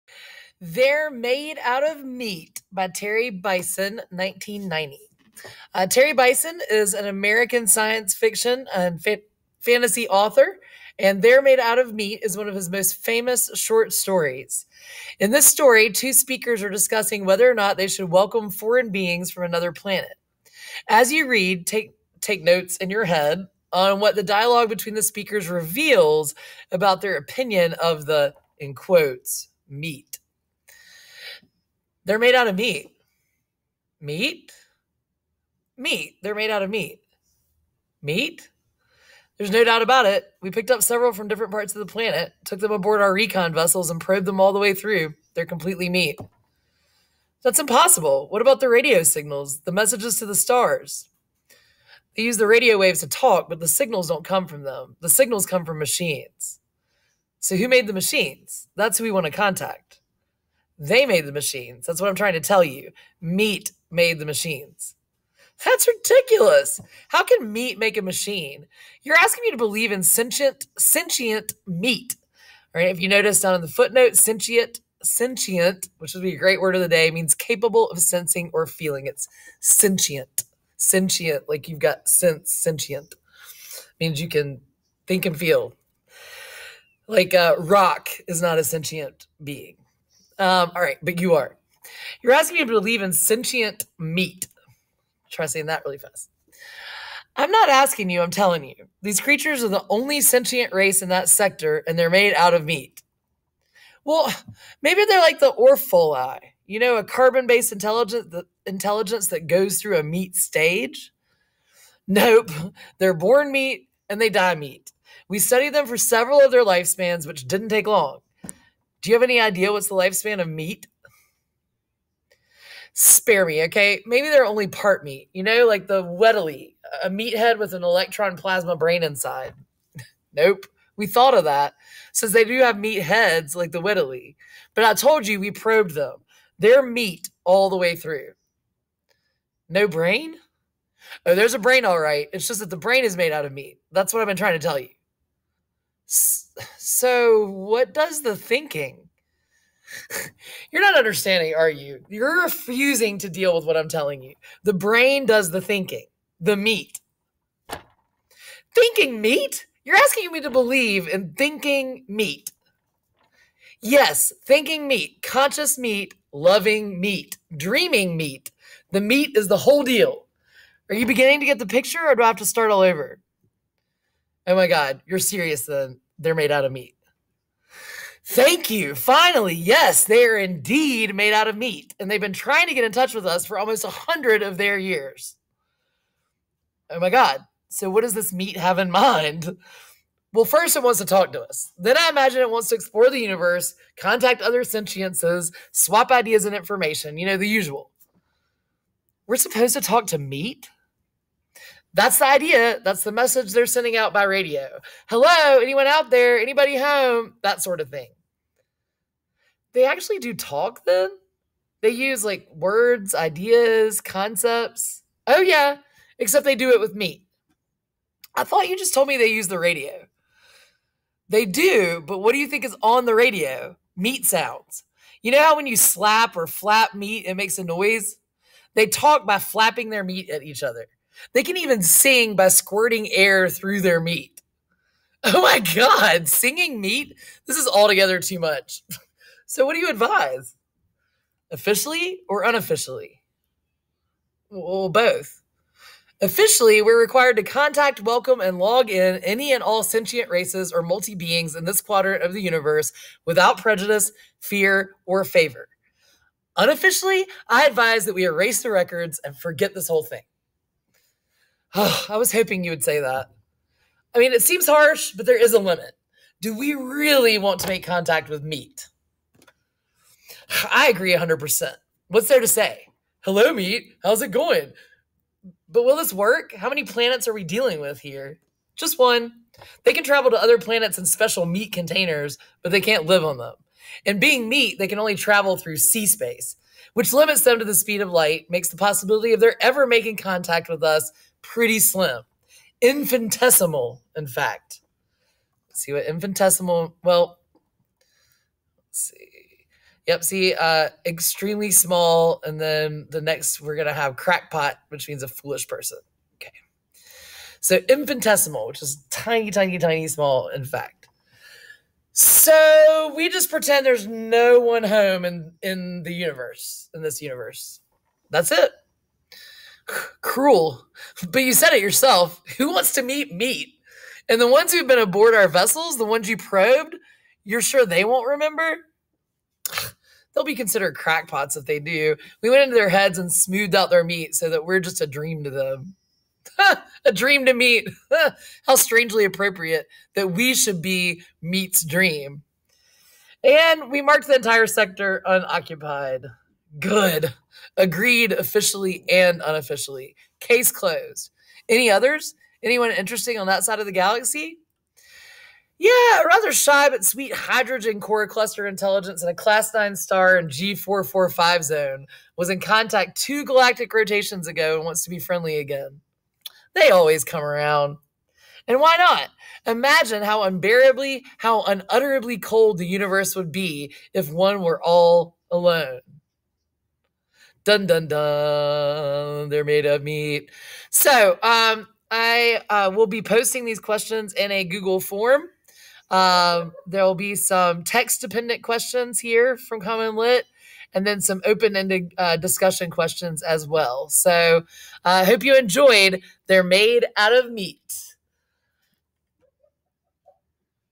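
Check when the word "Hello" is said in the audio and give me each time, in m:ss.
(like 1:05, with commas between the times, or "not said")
3:25, 4:33.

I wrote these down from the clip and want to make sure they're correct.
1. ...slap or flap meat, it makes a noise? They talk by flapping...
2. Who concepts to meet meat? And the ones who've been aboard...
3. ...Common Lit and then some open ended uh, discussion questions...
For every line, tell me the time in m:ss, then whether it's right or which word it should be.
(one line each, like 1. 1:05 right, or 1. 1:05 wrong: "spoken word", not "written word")
1. 3:45 right
2. 5:22 wrong: "wants", not "concepts"
3. 6:29 right.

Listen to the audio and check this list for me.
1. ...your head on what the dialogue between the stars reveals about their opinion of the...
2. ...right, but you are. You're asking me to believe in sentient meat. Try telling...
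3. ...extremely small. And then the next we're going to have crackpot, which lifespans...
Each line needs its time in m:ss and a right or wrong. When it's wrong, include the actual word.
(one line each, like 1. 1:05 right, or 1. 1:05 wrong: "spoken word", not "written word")
1. 0:22 wrong: "speakers", not "stars"
2. 1:30 wrong: "saying", not "telling"
3. 5:01 wrong: "means", not "lifespans".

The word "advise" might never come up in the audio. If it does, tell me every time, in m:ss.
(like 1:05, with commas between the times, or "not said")
3:59, 4:17.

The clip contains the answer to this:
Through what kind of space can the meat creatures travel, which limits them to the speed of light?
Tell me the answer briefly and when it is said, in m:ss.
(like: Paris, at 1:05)
C space, at 4:45.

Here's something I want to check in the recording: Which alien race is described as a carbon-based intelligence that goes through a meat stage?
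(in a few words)
Orfoli.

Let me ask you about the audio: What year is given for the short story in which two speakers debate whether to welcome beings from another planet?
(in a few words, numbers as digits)
1990.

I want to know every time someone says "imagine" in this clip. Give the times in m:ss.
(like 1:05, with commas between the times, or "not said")
3:12, 6:09.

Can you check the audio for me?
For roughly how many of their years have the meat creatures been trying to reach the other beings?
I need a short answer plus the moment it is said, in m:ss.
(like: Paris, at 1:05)
almost 100, at 3:03.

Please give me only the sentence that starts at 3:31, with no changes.
They use like words, ideas, concepts.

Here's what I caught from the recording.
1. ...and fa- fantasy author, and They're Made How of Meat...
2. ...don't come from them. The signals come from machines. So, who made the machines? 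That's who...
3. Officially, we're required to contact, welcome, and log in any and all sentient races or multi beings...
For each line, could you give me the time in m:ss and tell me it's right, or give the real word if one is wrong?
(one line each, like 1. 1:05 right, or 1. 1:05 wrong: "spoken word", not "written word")
1. 0:08 wrong: "Out", not "How"
2. 0:54 right
3. 4:06 right.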